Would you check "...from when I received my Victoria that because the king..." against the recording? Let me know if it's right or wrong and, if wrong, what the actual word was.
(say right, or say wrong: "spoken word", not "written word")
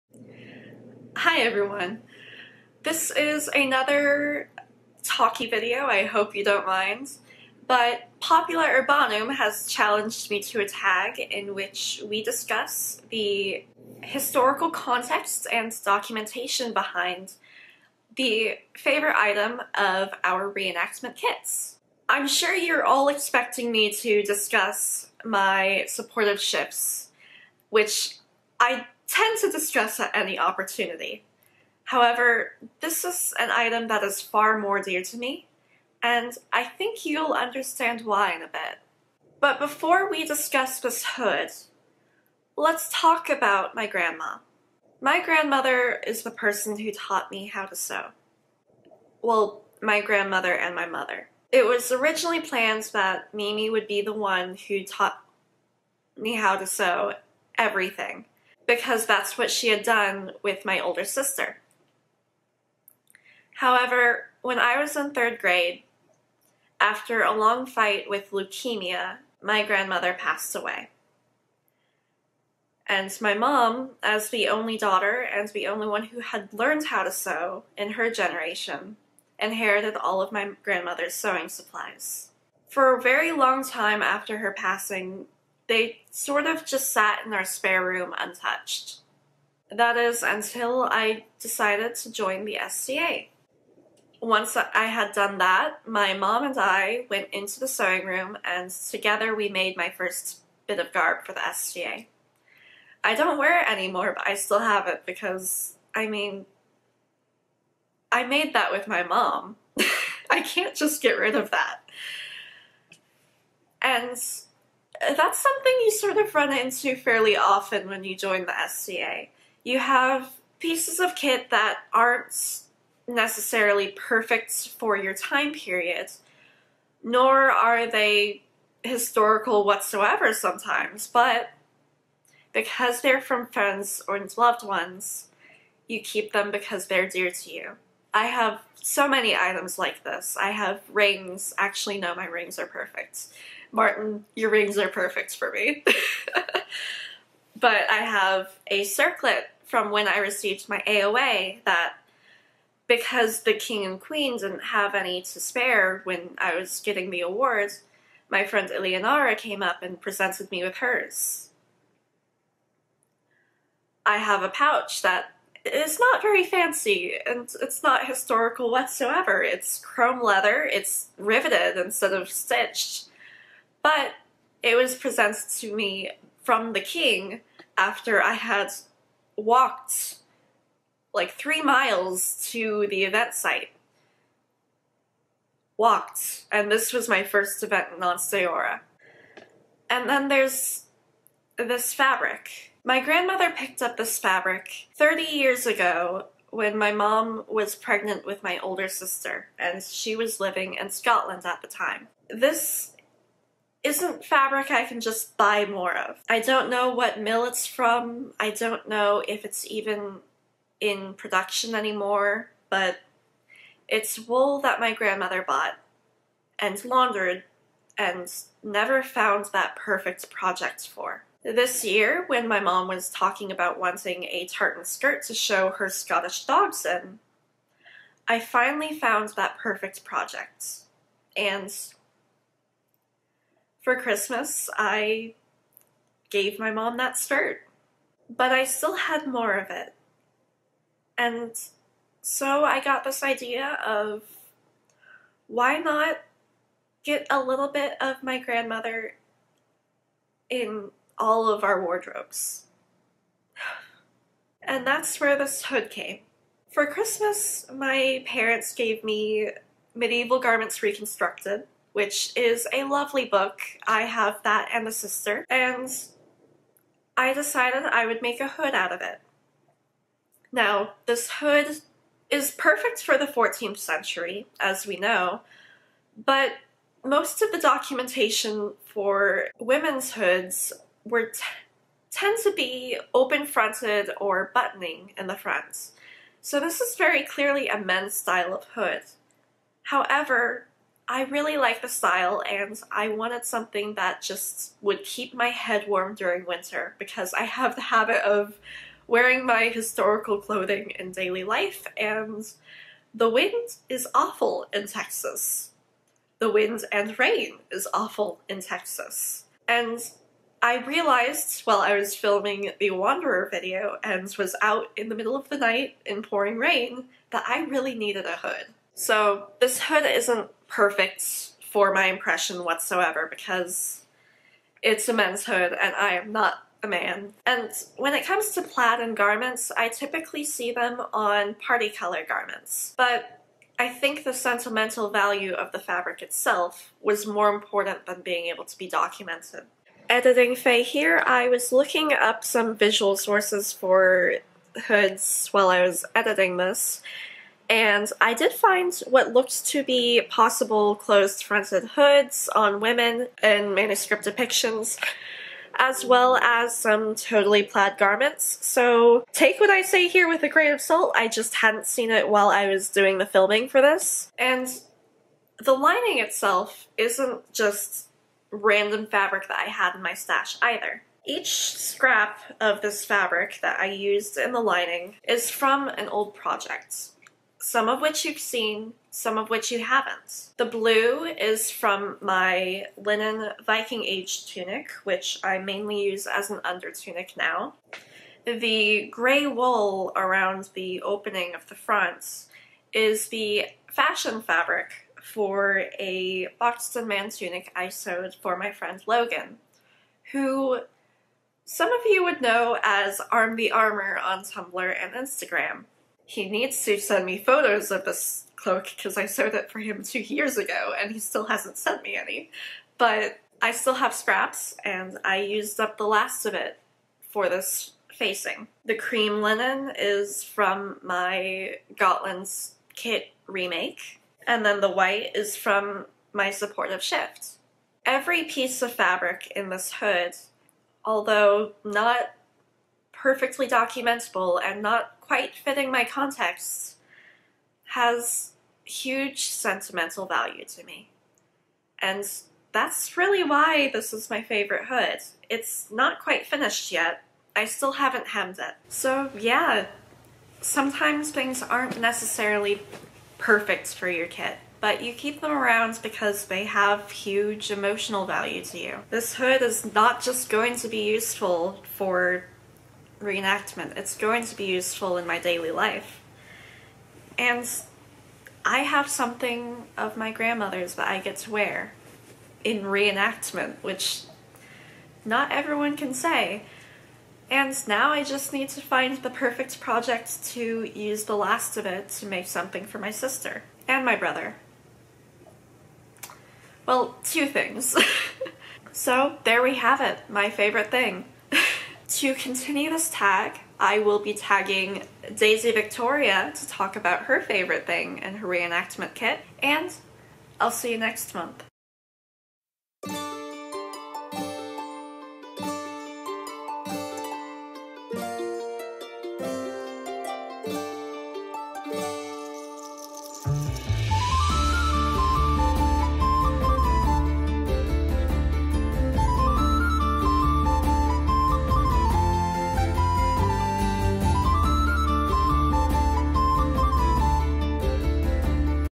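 wrong: "AOA", not "Victoria".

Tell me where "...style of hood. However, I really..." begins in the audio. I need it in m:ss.
4:48.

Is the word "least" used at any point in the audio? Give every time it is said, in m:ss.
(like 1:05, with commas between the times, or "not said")
not said.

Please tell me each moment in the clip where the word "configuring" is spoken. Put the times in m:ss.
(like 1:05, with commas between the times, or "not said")
not said.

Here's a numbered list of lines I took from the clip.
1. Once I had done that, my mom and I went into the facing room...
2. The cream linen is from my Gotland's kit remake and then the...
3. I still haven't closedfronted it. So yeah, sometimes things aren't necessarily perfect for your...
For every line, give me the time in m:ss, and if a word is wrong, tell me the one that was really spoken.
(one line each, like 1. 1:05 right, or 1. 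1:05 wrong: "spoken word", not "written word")
1. 1:34 wrong: "sewing", not "facing"
2. 6:58 right
3. 7:27 wrong: "hemmed", not "closedfronted".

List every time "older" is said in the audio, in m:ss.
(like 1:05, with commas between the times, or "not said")
1:00, 3:18.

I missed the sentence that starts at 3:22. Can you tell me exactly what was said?
This isn't fabric I can just buy more of.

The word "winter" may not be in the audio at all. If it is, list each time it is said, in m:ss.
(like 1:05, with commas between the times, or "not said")
4:56.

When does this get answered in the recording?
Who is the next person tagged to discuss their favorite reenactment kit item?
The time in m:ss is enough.
8:15.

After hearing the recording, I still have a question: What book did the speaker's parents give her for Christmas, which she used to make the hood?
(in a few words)
Medieval Garments Reconstructed.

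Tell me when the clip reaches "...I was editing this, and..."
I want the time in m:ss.
5:45.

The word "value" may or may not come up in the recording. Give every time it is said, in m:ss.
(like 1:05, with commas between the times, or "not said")
5:35, 7:20, 7:38.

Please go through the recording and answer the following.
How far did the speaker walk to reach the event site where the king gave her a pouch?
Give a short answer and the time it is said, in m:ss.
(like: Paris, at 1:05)
3 miles, at 3:01.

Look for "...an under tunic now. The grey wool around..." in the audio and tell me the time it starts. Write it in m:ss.
6:26.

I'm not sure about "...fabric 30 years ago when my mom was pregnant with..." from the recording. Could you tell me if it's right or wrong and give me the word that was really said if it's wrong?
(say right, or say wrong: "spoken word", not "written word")
right.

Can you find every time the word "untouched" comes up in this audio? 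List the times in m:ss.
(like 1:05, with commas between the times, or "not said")
1:28.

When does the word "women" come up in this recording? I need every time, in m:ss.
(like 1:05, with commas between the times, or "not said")
4:39, 5:52.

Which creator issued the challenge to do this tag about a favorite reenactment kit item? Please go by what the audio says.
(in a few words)
Popular Urbanum.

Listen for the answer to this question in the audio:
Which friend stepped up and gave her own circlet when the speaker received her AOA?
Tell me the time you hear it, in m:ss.
2:38.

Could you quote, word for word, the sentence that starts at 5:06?
The wind and rain is awful in Texas.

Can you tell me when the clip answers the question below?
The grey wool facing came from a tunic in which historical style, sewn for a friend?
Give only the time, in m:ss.
6:36.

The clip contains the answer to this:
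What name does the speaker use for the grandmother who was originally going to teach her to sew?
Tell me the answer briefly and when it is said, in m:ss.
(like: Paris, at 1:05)
Mimi, at 0:53.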